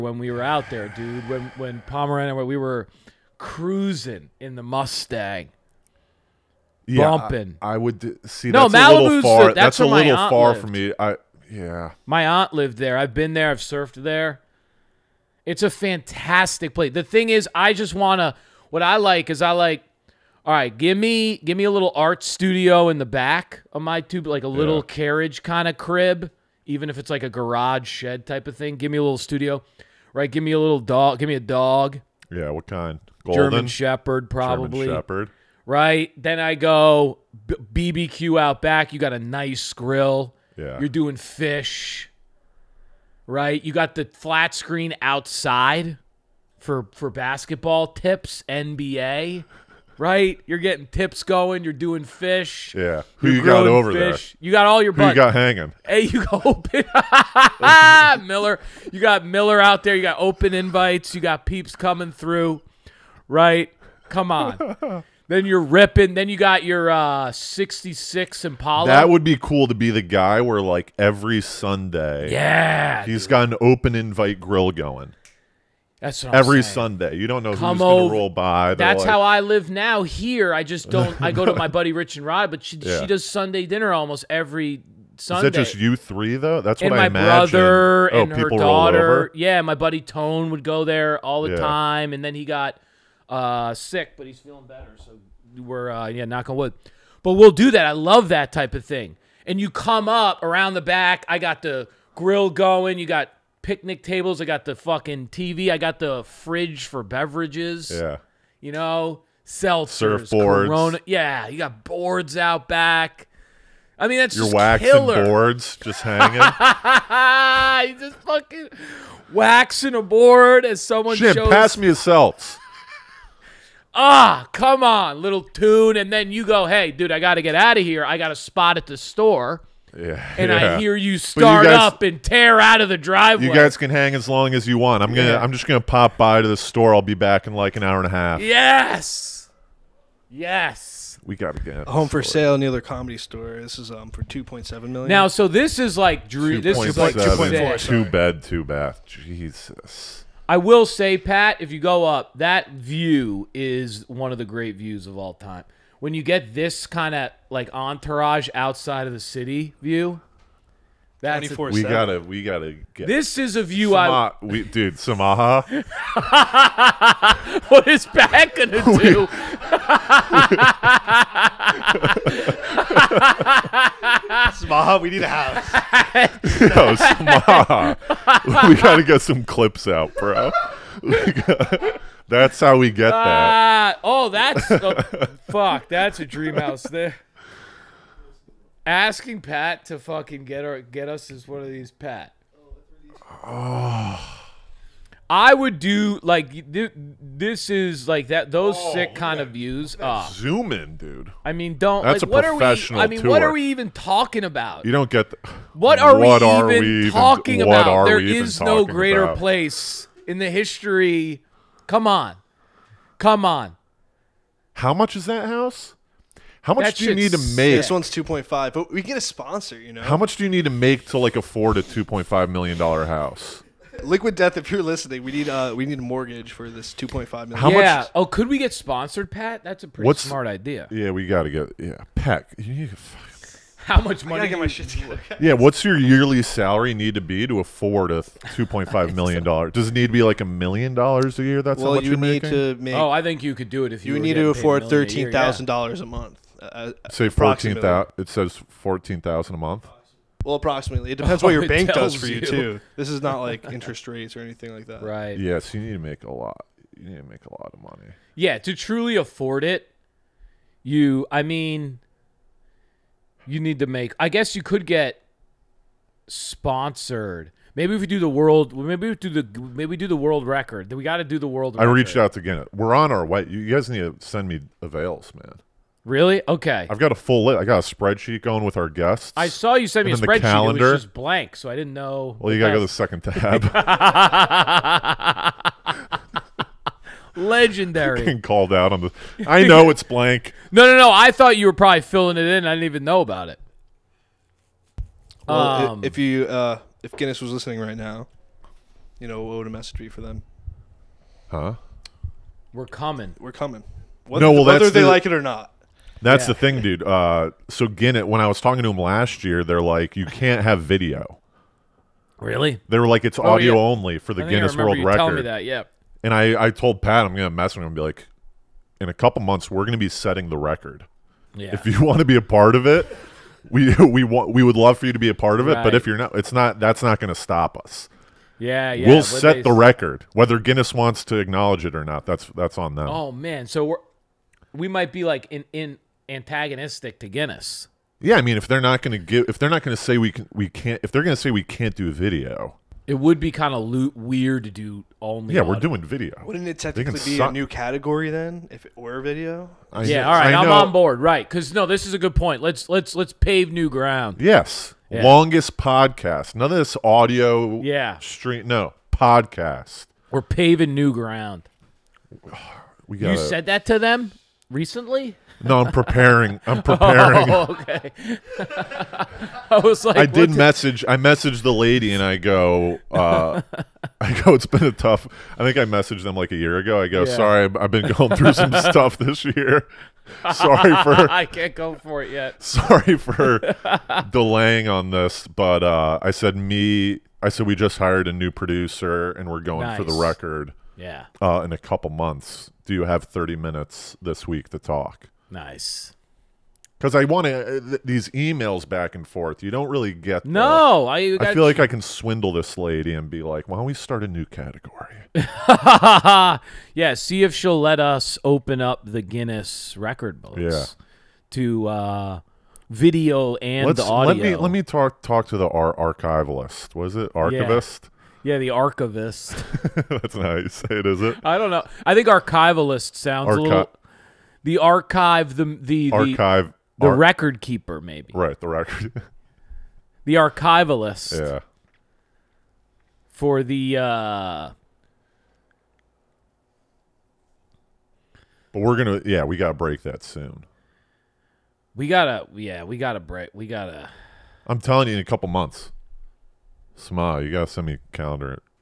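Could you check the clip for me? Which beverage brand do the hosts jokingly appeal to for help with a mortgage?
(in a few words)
Liquid Death.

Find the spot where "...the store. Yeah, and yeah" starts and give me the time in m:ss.
2:08.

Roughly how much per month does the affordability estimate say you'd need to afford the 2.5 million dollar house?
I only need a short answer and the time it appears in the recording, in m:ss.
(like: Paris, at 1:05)
14,000, at 4:08.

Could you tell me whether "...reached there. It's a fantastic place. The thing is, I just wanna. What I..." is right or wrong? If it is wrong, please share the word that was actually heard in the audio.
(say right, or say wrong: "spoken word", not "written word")
wrong: "surfed", not "reached".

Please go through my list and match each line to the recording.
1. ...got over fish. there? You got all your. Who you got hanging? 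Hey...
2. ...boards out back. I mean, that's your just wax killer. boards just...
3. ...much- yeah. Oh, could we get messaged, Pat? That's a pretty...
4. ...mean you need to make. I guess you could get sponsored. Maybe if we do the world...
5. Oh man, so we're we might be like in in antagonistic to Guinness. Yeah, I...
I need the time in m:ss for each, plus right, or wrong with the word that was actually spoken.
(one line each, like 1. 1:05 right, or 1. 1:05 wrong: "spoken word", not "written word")
1. 0:53 right
2. 1:51 right
3. 3:47 wrong: "sponsored", not "messaged"
4. 4:21 right
5. 5:33 right.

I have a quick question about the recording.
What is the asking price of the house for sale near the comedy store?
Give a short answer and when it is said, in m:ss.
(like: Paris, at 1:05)
2.7 million, at 2:24.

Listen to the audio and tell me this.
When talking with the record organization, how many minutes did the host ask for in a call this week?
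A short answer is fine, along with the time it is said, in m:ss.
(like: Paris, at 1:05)
30, at 6:33.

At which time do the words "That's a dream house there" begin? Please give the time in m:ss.
3:05.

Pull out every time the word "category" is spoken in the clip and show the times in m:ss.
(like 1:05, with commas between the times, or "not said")
5:47, 6:44.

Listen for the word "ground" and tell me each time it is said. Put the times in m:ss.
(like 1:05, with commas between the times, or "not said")
5:53, 6:01.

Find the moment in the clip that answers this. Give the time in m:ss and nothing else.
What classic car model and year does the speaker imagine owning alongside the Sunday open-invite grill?
1:07.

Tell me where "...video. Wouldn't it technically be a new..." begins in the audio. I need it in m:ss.
5:45.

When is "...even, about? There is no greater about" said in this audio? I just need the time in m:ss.
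3:27.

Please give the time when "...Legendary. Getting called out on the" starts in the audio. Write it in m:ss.
4:47.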